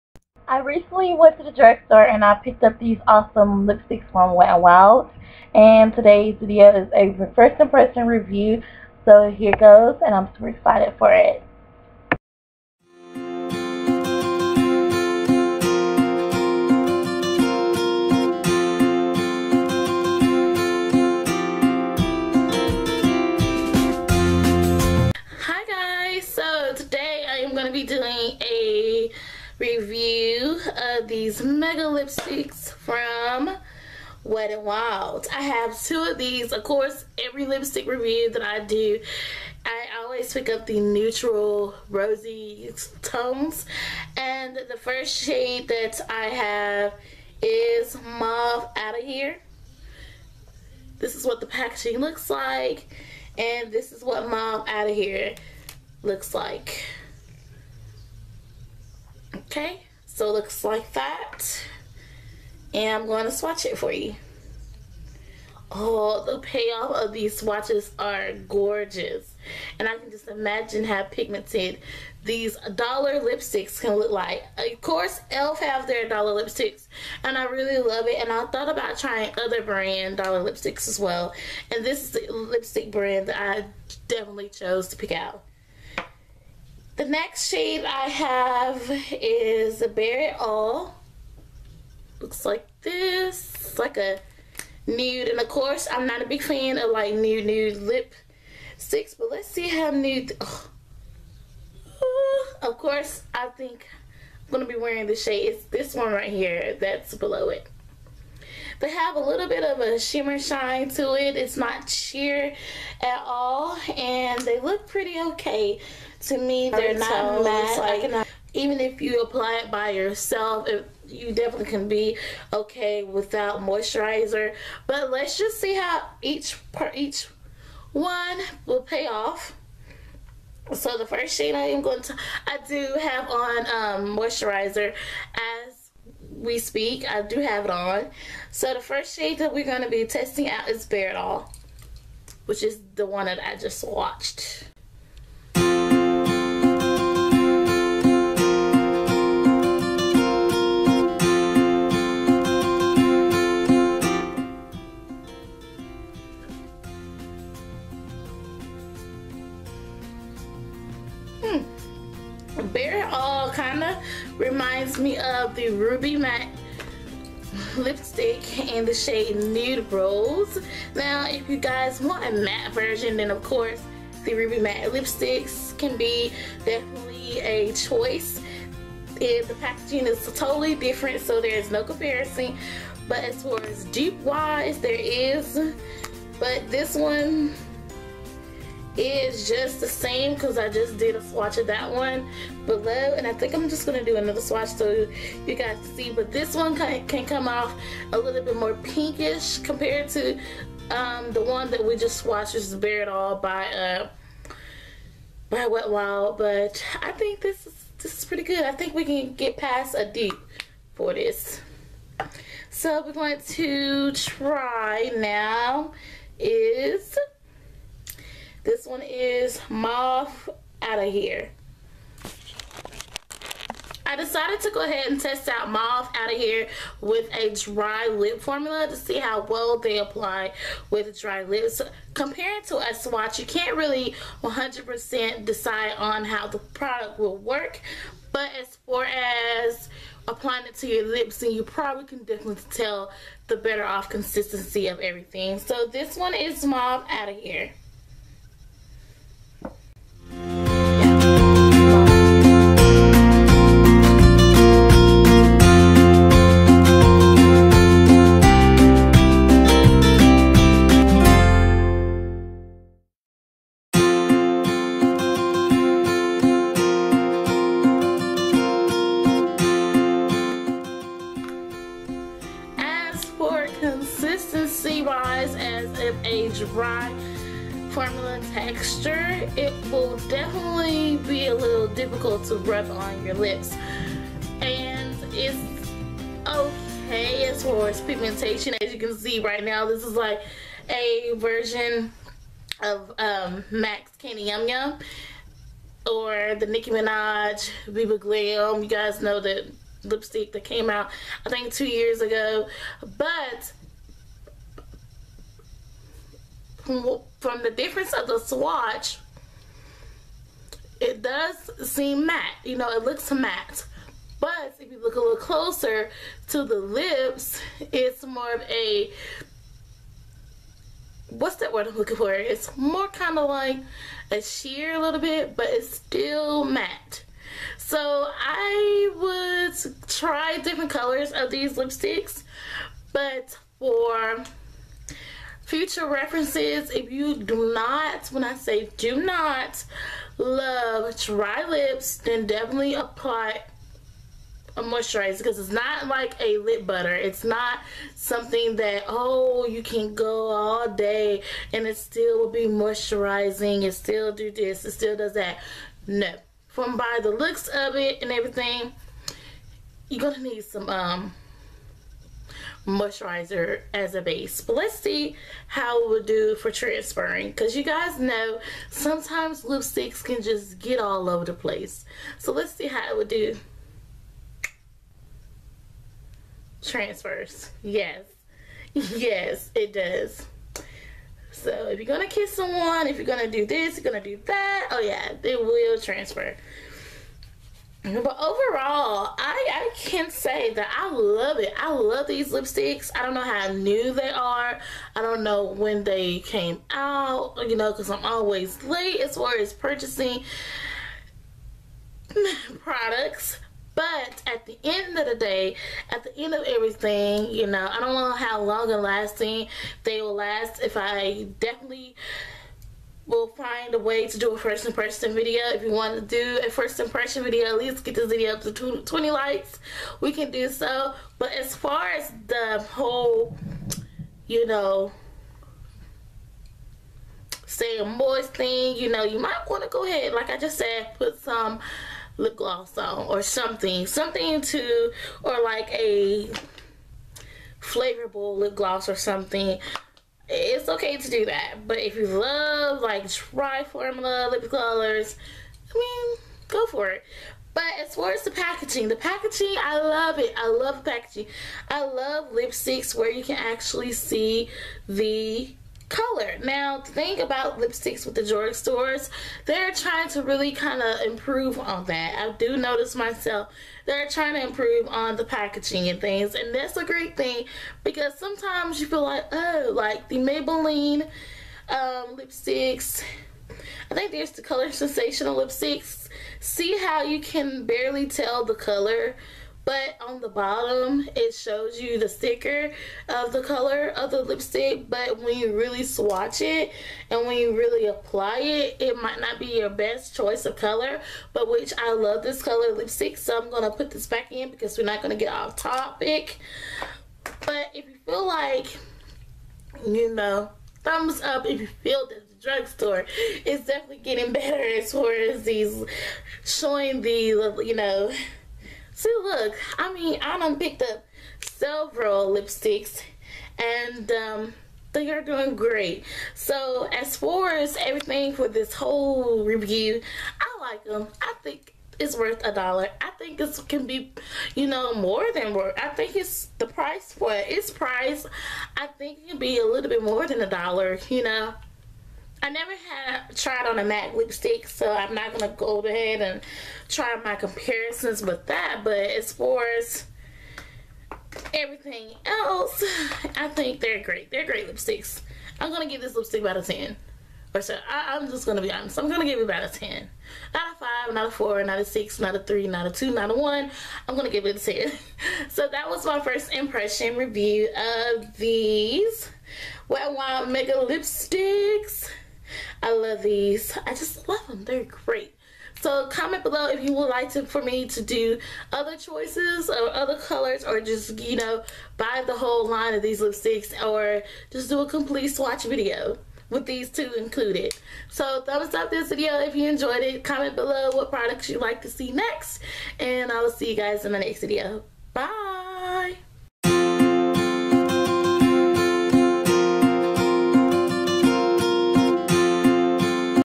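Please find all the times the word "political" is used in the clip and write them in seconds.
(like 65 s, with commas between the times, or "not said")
not said.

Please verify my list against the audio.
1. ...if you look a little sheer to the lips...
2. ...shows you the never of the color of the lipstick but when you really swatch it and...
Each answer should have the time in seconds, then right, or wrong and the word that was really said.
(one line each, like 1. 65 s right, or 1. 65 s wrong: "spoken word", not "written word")
1. 314 s wrong: "closer", not "sheer"
2. 481 s wrong: "sticker", not "never".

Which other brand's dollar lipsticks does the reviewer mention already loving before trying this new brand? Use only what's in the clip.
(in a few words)
e.l.f.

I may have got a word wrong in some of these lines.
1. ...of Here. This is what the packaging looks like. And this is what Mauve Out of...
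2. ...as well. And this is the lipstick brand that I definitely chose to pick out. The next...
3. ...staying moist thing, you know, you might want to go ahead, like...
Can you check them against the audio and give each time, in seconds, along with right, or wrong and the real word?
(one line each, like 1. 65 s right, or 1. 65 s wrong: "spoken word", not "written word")
1. 48 s right
2. 80 s right
3. 427 s right.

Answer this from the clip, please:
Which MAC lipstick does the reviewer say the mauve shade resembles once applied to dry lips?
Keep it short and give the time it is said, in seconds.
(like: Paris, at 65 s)
Candy Yum Yum, at 294 s.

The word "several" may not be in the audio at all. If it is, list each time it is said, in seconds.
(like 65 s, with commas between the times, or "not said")
511 s.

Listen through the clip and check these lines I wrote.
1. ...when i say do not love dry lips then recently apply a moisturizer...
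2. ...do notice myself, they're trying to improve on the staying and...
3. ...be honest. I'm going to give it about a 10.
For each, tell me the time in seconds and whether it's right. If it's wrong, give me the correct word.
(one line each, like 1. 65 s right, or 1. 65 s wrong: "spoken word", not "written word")
1. 338 s wrong: "definitely", not "recently"
2. 462 s wrong: "packaging", not "staying"
3. 548 s right.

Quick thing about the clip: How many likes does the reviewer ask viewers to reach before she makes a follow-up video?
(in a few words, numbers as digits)
20.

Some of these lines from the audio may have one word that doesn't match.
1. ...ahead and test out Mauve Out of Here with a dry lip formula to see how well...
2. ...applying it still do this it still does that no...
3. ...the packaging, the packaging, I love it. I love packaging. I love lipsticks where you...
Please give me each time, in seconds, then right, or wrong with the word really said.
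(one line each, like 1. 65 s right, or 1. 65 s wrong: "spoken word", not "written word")
1. 224 s right
2. 352 s wrong: "moisturizing", not "applying"
3. 448 s right.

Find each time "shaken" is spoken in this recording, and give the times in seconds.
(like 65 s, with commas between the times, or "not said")
not said.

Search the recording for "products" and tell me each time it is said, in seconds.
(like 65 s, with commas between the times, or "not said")
236 s, 402 s, 581 s.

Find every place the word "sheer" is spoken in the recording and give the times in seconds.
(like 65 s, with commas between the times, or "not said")
111 s, 324 s.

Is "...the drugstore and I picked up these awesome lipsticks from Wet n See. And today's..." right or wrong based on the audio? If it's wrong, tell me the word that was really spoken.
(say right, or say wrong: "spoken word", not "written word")
wrong: "Wild", not "See".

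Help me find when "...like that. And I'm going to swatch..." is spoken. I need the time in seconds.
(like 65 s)
60 s.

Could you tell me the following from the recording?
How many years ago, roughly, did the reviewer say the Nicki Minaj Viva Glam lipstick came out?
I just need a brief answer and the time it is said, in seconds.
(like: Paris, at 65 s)
2, at 301 s.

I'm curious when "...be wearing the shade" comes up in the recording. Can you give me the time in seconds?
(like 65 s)
104 s.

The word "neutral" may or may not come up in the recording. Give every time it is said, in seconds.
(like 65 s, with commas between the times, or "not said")
40 s.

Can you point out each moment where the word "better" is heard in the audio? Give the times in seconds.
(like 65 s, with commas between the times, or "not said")
243 s, 504 s.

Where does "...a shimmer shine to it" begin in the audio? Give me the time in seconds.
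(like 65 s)
109 s.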